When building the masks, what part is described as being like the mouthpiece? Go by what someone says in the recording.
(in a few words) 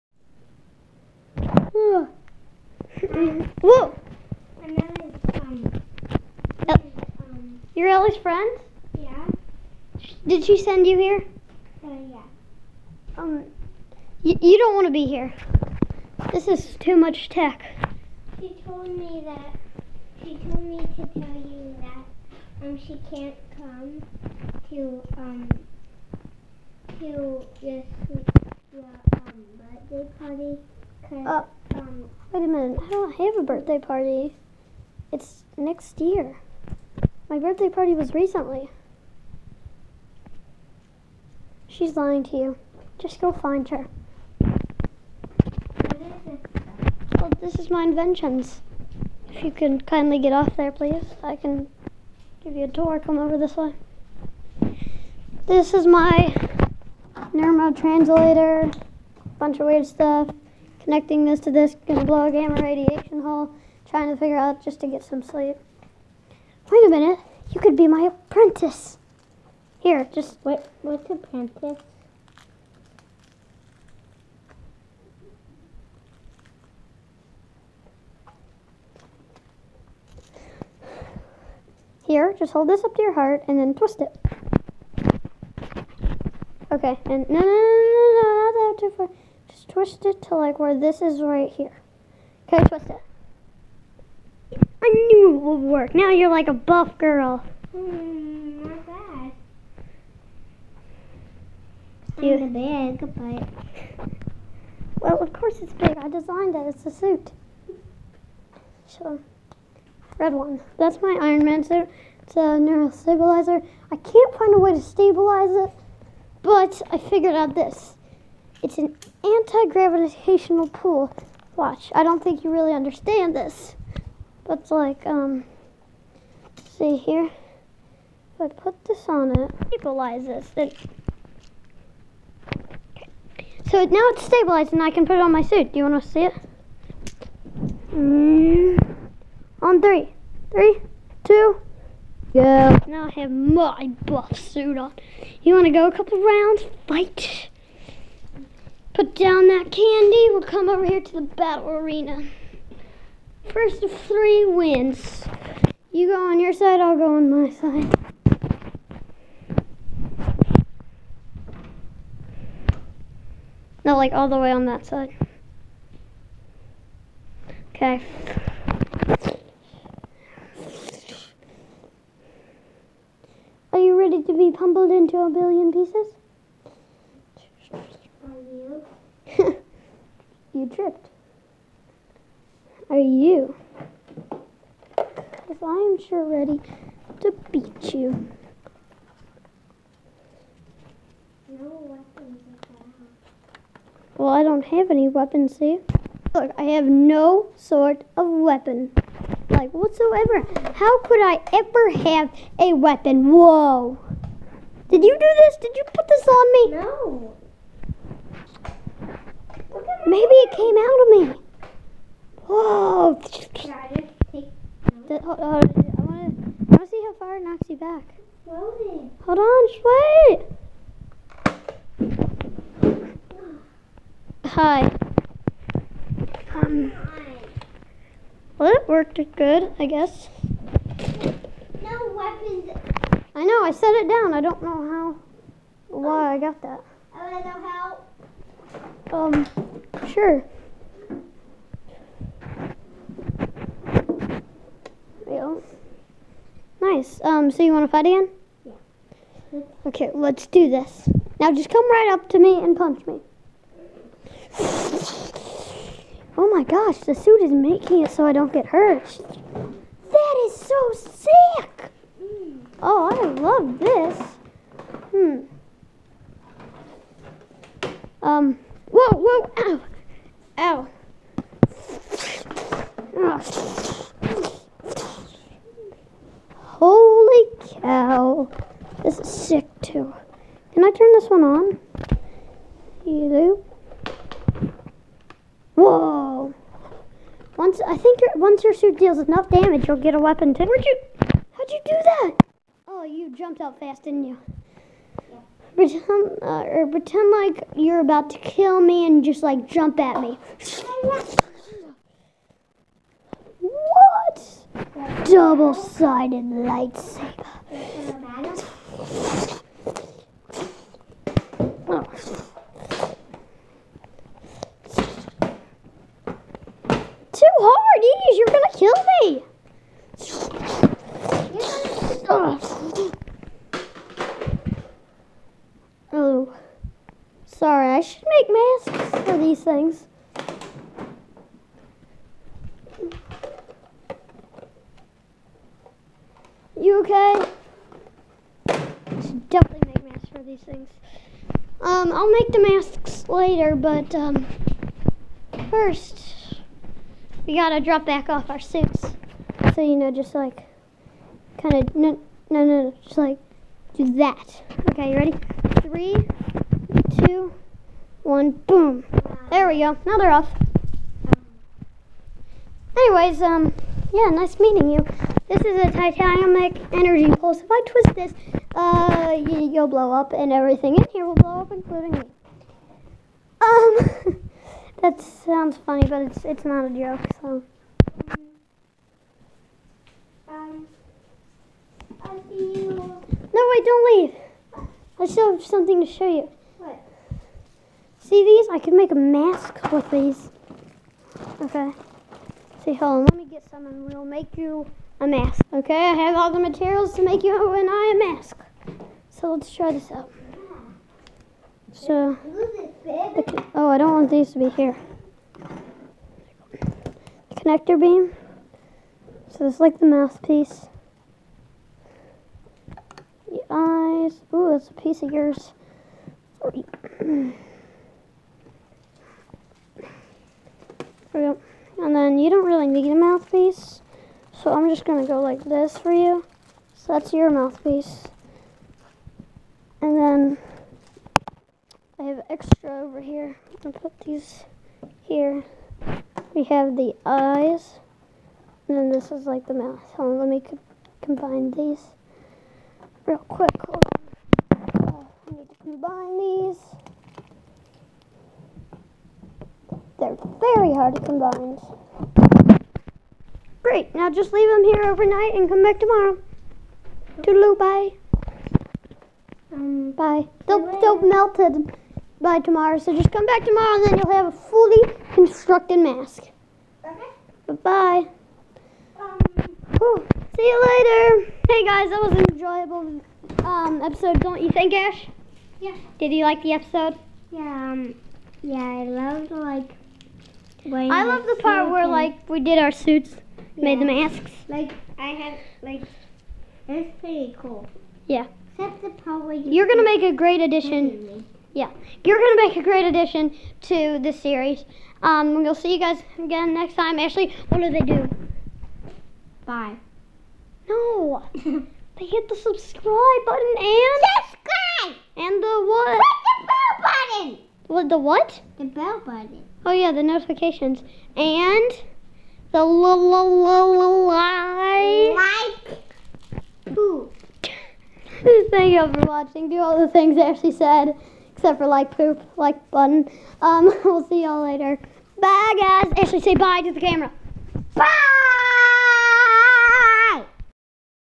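connector beam.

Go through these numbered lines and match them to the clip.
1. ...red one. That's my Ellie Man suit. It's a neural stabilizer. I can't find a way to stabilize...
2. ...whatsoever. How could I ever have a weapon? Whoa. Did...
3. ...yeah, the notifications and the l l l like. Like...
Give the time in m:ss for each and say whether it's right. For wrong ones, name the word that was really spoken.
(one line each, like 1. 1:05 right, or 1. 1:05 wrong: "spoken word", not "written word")
1. 1:50 wrong: "Iron", not "Ellie"
2. 3:19 right
3. 8:29 right.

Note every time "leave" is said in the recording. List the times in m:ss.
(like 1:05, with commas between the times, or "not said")
6:24, 7:34.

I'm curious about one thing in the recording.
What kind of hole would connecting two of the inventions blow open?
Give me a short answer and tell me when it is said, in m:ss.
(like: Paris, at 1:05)
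gamma radiation hole, at 1:02.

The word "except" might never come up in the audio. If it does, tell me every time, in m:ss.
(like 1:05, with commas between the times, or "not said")
8:08, 8:41.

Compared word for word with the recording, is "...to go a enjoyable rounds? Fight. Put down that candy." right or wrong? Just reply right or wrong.
wrong.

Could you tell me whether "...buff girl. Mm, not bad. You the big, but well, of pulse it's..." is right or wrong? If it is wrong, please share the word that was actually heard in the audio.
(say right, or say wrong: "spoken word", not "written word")
wrong: "course", not "pulse".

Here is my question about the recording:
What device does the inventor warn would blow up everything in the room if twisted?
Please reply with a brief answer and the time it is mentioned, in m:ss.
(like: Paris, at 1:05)
titanic energy pulse, at 6:05.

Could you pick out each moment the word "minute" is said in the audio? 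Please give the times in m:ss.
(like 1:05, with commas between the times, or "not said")
0:32, 1:06.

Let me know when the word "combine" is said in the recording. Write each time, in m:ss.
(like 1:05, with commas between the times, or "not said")
7:21, 7:25, 7:31.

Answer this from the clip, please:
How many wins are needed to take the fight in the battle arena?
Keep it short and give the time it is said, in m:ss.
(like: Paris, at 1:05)
3, at 2:33.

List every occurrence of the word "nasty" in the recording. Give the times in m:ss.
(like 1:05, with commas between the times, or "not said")
not said.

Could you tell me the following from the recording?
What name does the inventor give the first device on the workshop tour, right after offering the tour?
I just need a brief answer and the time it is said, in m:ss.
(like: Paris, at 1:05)
neuromod translator, at 0:57.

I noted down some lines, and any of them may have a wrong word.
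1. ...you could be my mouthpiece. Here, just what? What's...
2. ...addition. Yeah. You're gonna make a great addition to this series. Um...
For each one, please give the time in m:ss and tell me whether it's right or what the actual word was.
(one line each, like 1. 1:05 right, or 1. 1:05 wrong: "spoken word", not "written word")
1. 1:07 wrong: "apprentice", not "mouthpiece"
2. 8:10 right.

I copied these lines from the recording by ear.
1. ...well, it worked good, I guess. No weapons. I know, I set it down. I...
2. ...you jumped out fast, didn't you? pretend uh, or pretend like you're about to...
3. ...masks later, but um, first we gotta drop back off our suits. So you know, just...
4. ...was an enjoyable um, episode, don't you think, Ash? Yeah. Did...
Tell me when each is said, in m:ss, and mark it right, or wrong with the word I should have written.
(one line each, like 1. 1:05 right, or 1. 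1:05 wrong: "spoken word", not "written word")
1. 3:48 right
2. 4:53 right
3. 5:42 right
4. 7:52 right.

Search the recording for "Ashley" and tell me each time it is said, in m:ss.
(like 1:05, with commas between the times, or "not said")
8:17, 8:40, 8:46.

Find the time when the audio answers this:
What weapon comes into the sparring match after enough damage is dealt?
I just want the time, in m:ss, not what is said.
5:05.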